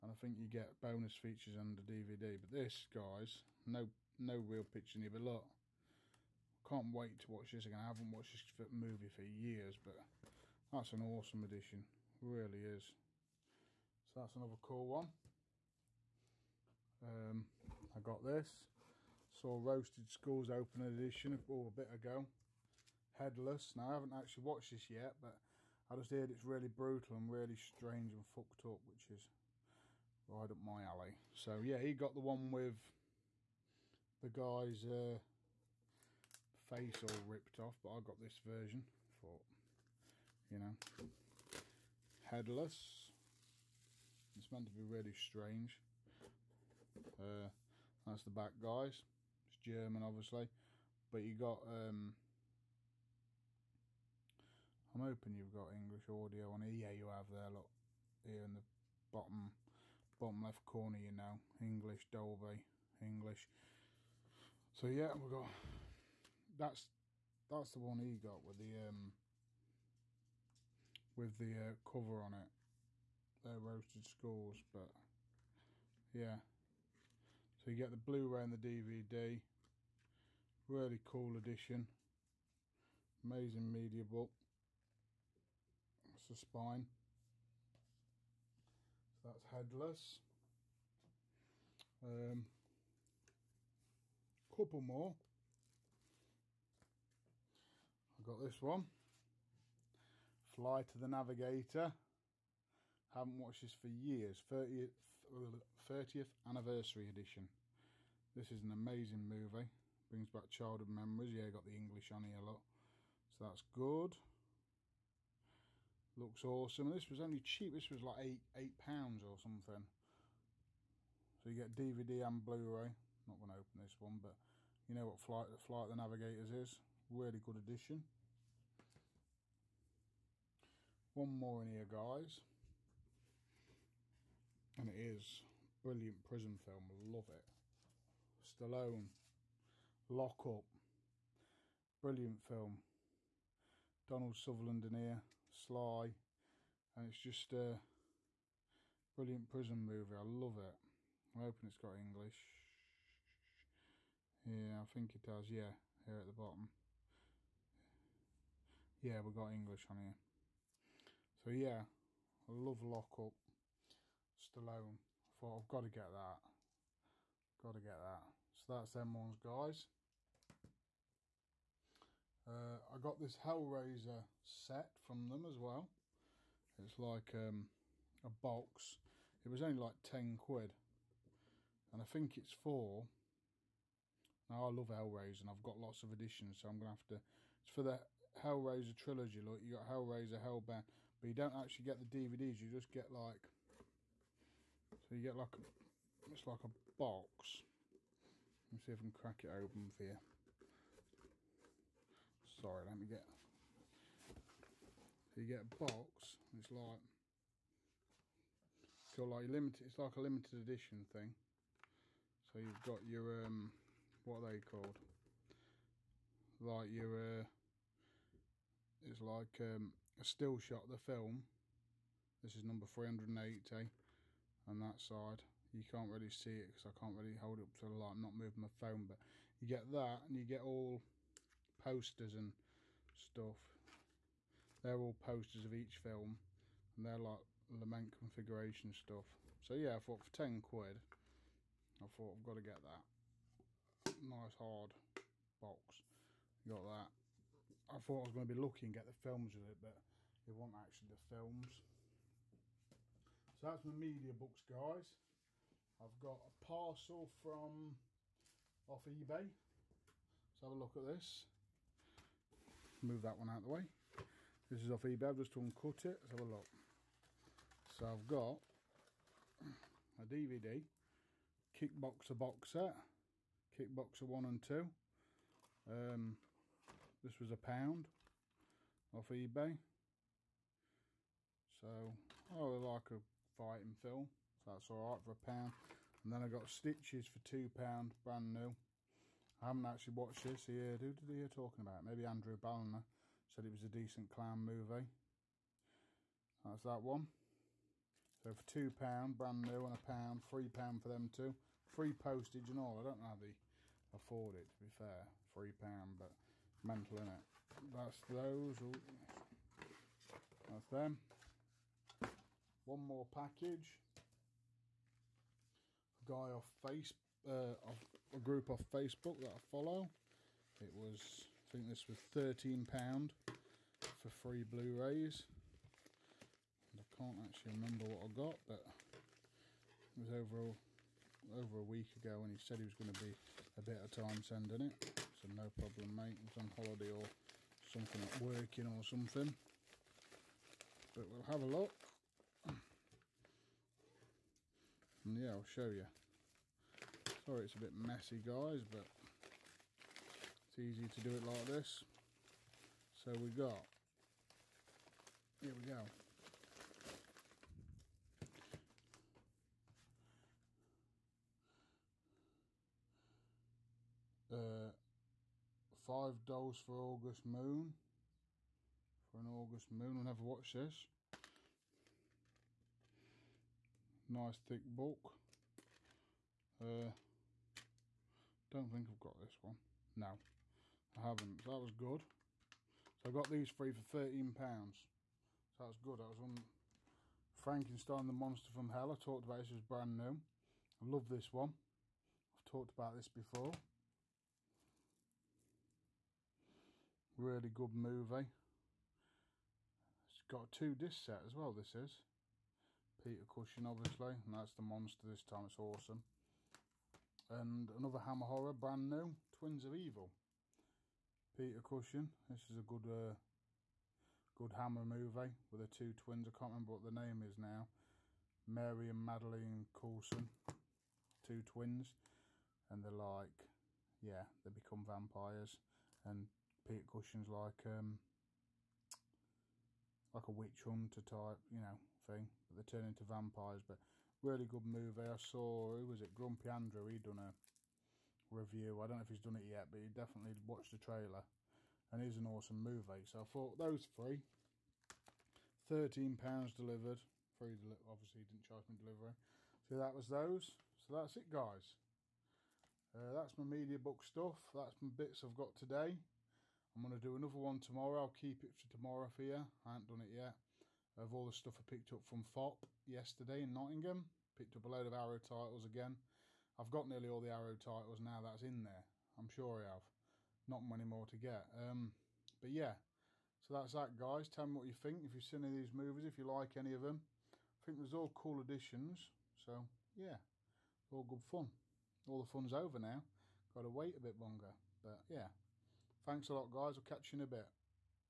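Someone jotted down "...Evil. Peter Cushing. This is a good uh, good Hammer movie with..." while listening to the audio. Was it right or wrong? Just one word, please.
right.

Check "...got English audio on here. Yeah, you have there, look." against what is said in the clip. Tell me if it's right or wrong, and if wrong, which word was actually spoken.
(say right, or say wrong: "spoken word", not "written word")
right.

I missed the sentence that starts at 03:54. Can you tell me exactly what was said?
They're all posters of each film and they're like lament configuration stuff.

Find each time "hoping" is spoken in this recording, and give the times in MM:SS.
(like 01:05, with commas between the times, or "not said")
00:55, 02:31.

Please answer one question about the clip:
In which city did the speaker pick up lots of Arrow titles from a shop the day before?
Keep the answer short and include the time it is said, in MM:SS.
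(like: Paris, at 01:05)
Nottingham, at 07:43.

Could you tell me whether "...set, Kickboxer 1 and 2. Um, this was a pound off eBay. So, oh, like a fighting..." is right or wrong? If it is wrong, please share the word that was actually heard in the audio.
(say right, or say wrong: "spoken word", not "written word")
right.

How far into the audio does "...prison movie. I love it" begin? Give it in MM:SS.
02:29.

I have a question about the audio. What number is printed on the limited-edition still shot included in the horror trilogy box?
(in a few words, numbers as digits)
380.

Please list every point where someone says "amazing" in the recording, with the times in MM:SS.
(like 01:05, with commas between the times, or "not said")
01:23, 01:48.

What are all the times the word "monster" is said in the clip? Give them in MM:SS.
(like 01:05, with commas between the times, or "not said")
06:28, 06:44.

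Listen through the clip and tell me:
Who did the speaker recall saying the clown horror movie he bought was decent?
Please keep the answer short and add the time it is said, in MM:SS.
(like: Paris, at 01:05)
Andrew Balliner, at 04:52.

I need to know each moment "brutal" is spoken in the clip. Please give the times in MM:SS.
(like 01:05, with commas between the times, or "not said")
00:26.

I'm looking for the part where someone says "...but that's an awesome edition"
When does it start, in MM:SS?
00:09.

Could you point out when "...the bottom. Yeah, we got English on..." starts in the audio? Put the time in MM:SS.
02:36.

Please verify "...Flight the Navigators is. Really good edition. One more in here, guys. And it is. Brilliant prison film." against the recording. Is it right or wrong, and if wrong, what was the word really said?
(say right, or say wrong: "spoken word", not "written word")
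right.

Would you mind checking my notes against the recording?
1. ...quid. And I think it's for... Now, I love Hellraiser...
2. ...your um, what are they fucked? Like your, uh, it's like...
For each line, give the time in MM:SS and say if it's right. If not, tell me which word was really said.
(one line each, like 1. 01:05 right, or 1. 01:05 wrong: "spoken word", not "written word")
1. 03:00 right
2. 03:33 wrong: "called", not "fucked".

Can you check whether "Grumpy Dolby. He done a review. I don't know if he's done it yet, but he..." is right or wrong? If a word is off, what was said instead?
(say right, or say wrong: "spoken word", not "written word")
wrong: "Andrew", not "Dolby".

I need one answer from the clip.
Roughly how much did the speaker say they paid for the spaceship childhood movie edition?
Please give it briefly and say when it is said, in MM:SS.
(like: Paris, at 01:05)
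8 pounds, at 01:58.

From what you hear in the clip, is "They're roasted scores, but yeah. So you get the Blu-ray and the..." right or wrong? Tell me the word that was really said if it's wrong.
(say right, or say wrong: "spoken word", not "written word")
right.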